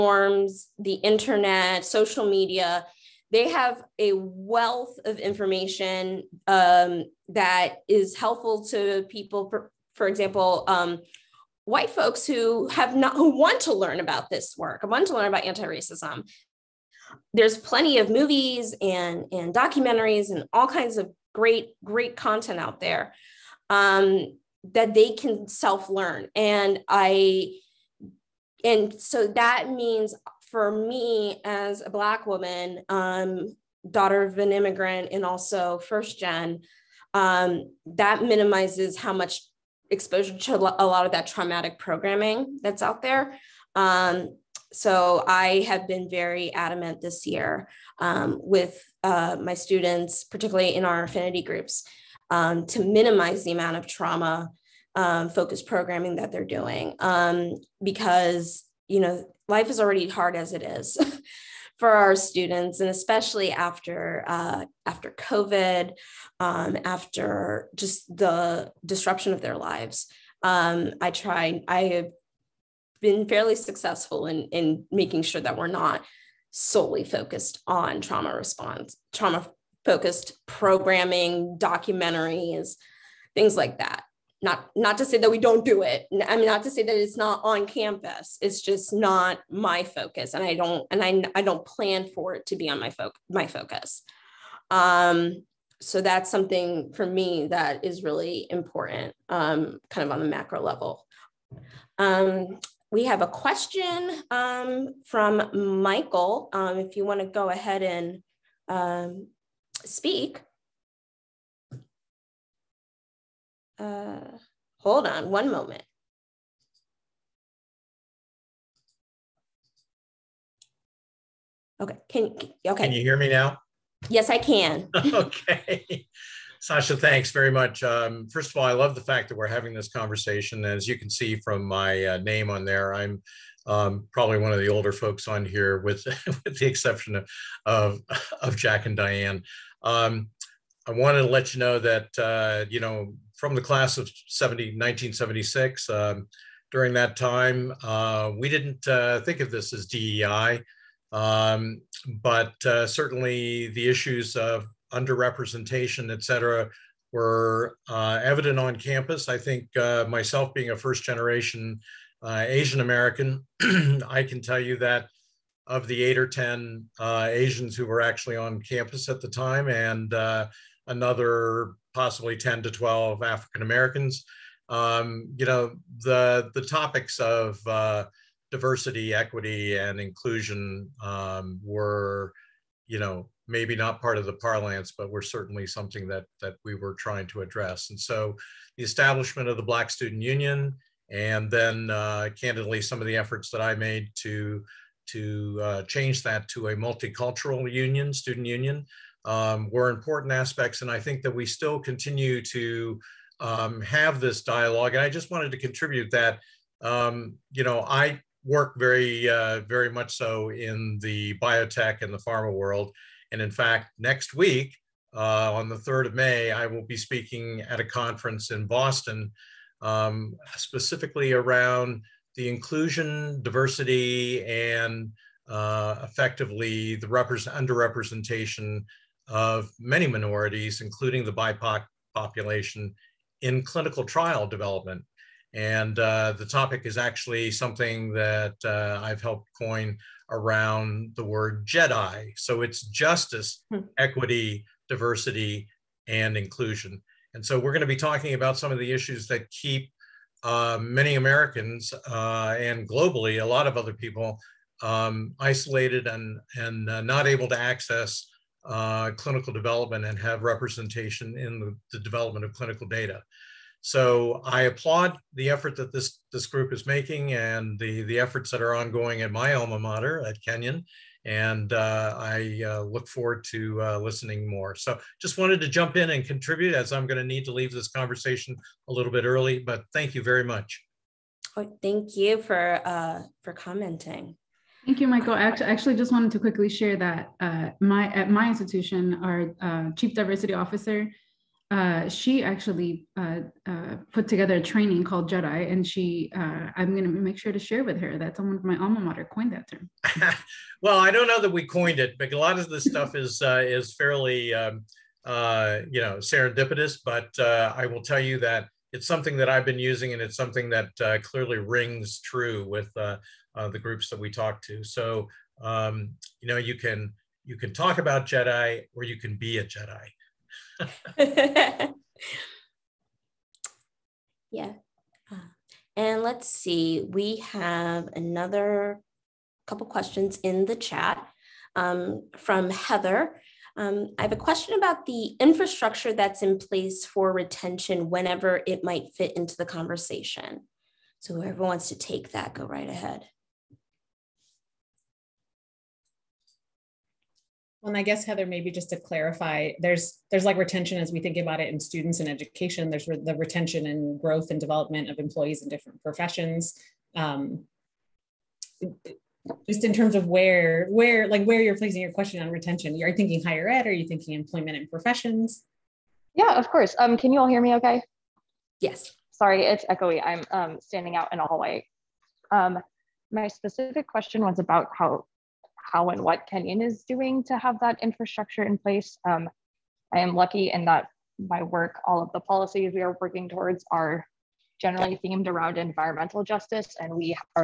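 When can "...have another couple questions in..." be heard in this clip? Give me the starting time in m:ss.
5:27.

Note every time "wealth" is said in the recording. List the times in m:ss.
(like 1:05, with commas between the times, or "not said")
0:04.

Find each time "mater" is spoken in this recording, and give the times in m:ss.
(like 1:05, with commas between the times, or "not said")
4:29, 4:58.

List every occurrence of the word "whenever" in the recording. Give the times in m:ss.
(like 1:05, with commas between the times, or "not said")
5:38.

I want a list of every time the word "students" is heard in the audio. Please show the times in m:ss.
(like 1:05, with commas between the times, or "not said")
0:49, 1:02, 3:09, 3:18, 5:51.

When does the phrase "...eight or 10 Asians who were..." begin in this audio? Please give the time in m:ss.
2:46.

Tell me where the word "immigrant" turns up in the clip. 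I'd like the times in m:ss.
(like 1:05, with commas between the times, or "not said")
0:34.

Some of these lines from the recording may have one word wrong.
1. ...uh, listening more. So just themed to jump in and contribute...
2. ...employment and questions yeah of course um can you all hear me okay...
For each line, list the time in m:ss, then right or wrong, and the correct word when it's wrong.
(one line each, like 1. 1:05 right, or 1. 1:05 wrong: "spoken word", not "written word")
1. 4:33 wrong: "wanted", not "themed"
2. 6:04 wrong: "professions", not "questions".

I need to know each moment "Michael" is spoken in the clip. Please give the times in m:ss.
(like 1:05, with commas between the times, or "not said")
1:45, 4:45.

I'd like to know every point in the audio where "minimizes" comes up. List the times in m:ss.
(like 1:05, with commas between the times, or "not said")
0:38, 0:52.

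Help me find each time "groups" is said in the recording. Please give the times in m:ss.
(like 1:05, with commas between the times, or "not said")
0:51, 4:26, 5:13.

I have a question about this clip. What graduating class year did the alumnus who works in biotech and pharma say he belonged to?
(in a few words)
1976.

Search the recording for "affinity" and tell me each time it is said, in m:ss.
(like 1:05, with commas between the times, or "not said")
0:51.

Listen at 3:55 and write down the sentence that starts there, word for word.
And uh, the topic is actually something that uh, I've helped coin around the word Jedi.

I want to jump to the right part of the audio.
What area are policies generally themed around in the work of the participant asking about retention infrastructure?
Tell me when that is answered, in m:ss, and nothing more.
6:25.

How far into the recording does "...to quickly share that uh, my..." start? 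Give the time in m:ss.
4:46.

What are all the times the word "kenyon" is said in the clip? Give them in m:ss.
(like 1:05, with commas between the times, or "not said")
4:30, 6:16.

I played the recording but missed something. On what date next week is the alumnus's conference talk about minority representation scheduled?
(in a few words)
May 3.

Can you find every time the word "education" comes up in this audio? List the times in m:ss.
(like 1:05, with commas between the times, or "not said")
5:52.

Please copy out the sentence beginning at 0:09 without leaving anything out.
For, for example, um, white folks who have not who want to learn about this work, want to learn about anti-racism.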